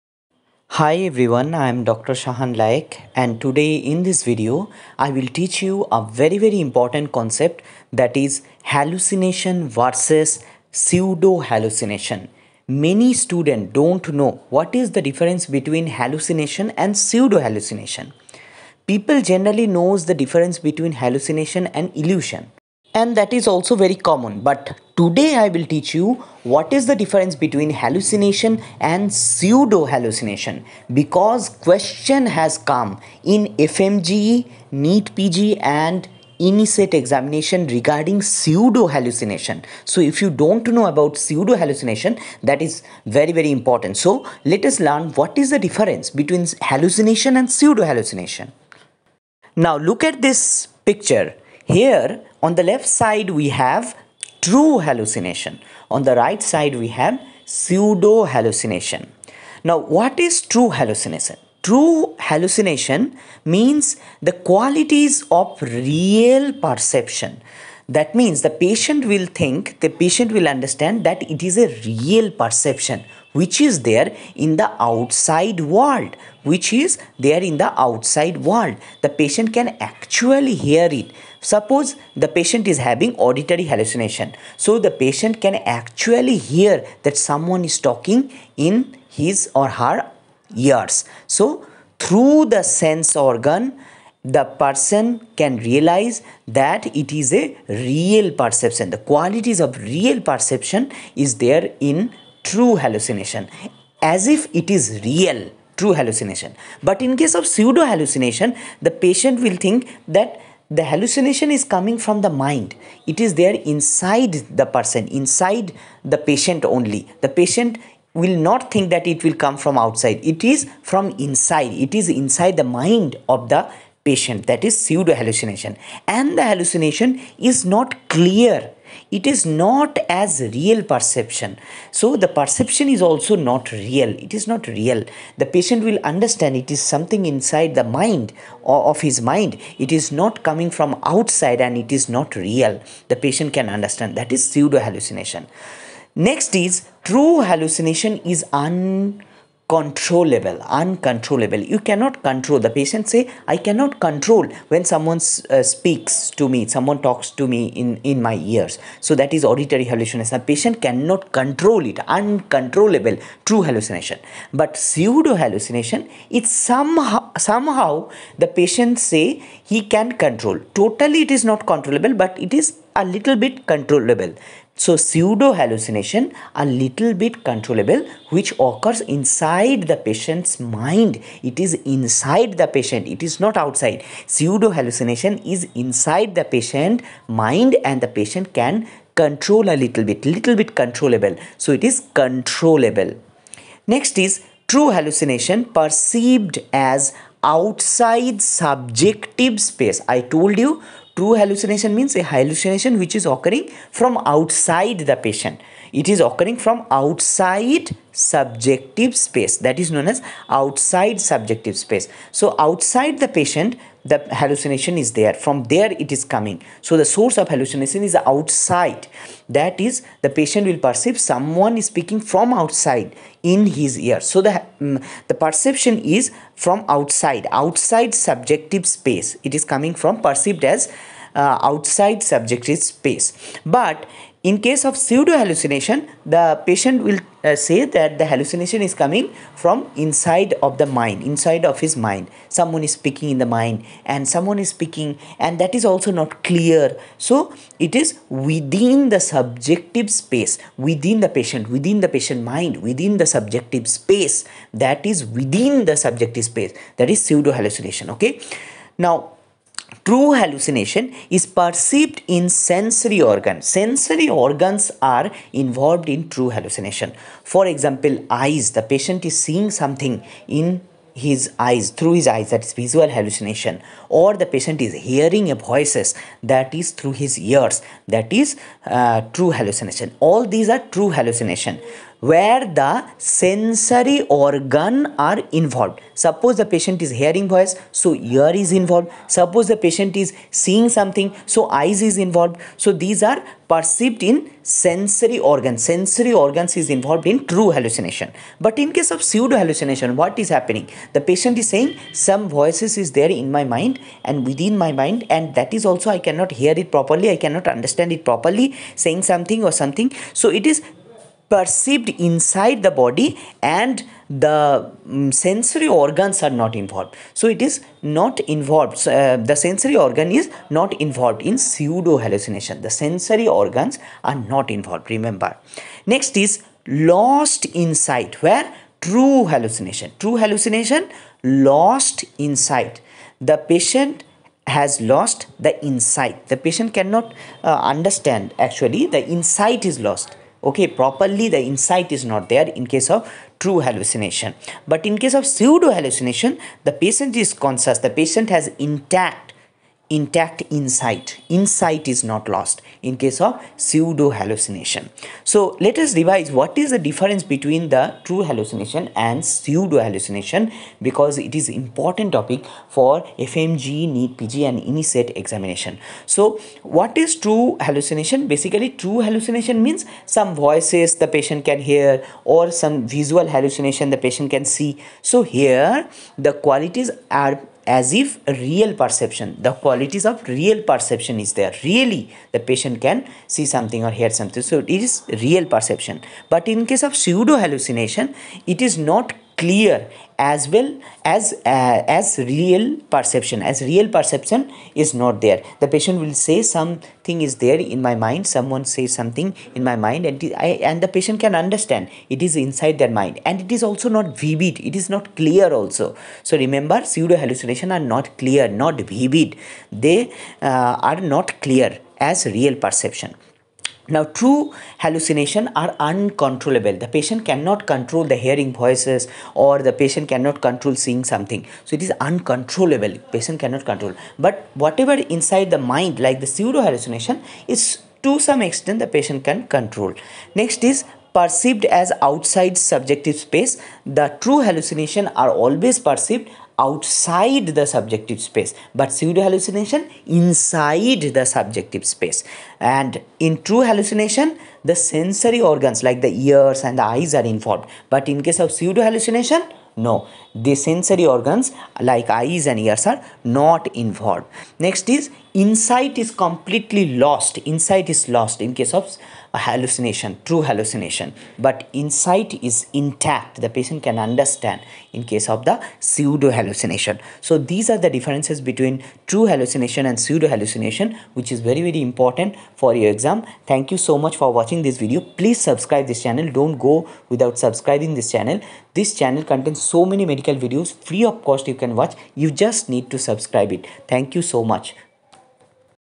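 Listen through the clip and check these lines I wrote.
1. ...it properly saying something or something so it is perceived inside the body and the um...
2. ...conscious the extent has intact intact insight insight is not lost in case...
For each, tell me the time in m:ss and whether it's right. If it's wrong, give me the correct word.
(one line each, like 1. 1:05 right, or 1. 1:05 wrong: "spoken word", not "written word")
1. 5:08 right
2. 5:47 wrong: "patient", not "extent".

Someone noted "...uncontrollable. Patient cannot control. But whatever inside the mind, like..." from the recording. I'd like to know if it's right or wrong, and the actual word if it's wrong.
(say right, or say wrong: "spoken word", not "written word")
right.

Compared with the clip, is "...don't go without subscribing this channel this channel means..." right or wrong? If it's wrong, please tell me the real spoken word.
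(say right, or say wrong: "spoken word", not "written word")
wrong: "contains", not "means".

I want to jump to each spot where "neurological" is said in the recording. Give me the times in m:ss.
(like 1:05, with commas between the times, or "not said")
not said.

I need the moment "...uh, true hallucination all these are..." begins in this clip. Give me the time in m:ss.
4:38.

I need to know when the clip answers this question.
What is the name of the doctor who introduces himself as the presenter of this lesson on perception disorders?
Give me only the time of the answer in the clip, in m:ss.
0:01.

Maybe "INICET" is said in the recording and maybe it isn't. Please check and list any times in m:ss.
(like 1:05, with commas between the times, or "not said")
0:36, 6:04.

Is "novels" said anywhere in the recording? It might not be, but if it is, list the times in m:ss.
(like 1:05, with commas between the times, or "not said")
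not said.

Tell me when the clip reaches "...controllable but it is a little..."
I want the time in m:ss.
2:51.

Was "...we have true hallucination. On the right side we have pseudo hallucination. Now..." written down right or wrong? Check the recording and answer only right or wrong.
right.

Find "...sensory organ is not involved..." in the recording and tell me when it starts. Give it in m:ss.
5:19.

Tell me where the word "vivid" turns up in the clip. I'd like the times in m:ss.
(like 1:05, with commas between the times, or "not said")
6:44, 6:49.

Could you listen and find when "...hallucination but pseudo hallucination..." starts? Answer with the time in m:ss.
2:43.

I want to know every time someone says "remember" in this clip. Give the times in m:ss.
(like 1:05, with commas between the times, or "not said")
5:25, 6:46.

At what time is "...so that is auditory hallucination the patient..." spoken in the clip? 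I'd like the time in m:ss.
2:39.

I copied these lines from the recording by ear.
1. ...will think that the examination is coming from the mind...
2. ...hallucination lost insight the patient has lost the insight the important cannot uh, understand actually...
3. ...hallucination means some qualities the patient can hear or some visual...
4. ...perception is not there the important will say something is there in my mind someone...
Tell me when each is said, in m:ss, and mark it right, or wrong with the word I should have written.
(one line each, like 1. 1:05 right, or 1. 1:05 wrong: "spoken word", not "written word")
1. 1:49 wrong: "hallucination", not "examination"
2. 5:30 wrong: "patient", not "important"
3. 6:09 wrong: "voices", not "qualities"
4. 6:34 wrong: "patient", not "important".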